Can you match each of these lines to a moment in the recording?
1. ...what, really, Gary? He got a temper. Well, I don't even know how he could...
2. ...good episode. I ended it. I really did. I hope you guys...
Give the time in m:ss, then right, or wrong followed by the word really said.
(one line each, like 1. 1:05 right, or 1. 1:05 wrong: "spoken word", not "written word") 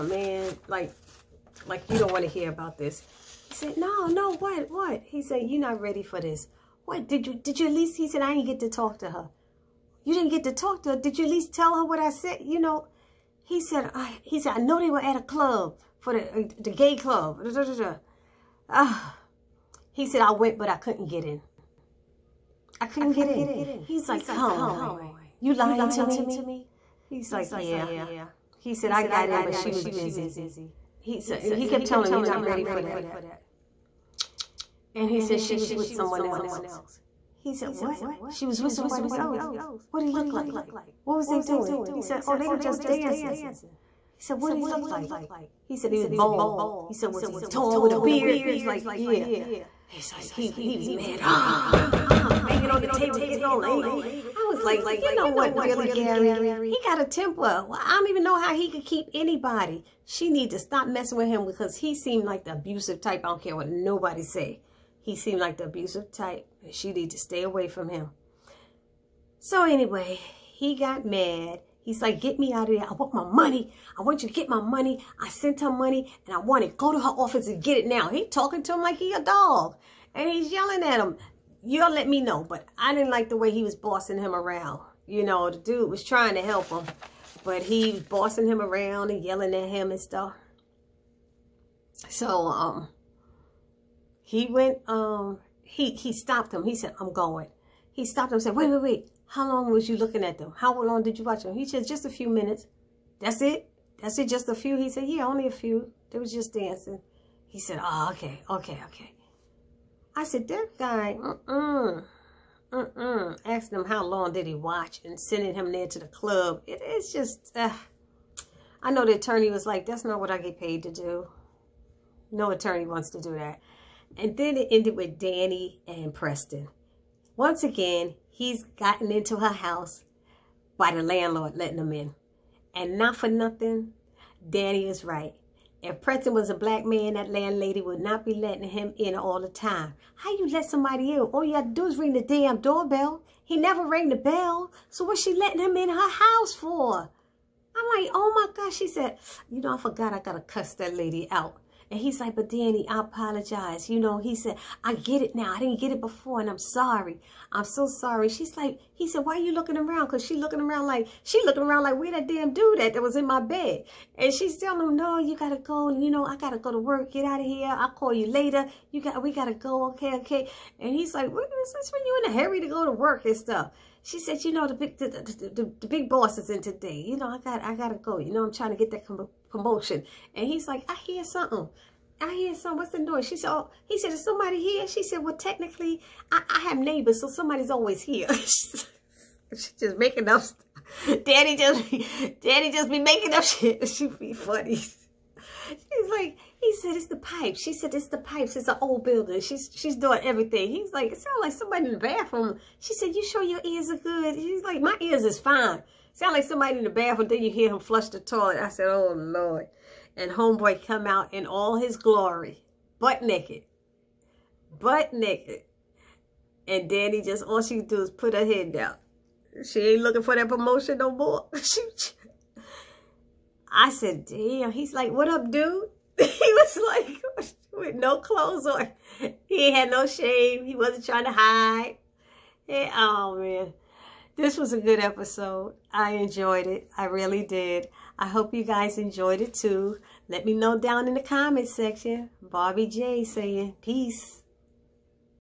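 1. 0:55 right
2. 3:54 wrong: "enjoyed", not "ended".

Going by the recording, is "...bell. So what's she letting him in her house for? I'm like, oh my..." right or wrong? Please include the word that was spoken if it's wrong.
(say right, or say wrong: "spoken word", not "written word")
right.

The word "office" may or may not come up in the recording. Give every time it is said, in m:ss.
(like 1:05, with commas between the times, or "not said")
1:17.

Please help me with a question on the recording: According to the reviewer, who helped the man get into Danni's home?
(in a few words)
the landlord.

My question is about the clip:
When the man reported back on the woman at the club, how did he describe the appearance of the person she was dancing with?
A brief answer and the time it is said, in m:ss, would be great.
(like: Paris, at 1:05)
bald, at 0:46.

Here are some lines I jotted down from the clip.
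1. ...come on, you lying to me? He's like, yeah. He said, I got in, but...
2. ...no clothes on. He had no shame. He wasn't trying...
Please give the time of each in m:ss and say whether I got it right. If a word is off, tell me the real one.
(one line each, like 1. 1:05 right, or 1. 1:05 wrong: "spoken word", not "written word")
1. 0:24 right
2. 3:47 right.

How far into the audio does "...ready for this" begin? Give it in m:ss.
0:05.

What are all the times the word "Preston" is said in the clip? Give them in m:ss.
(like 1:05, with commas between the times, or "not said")
2:06, 2:15.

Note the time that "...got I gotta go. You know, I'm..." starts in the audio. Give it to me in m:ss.
2:57.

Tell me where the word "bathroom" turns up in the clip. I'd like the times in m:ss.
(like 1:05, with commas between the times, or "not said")
3:21, 3:26.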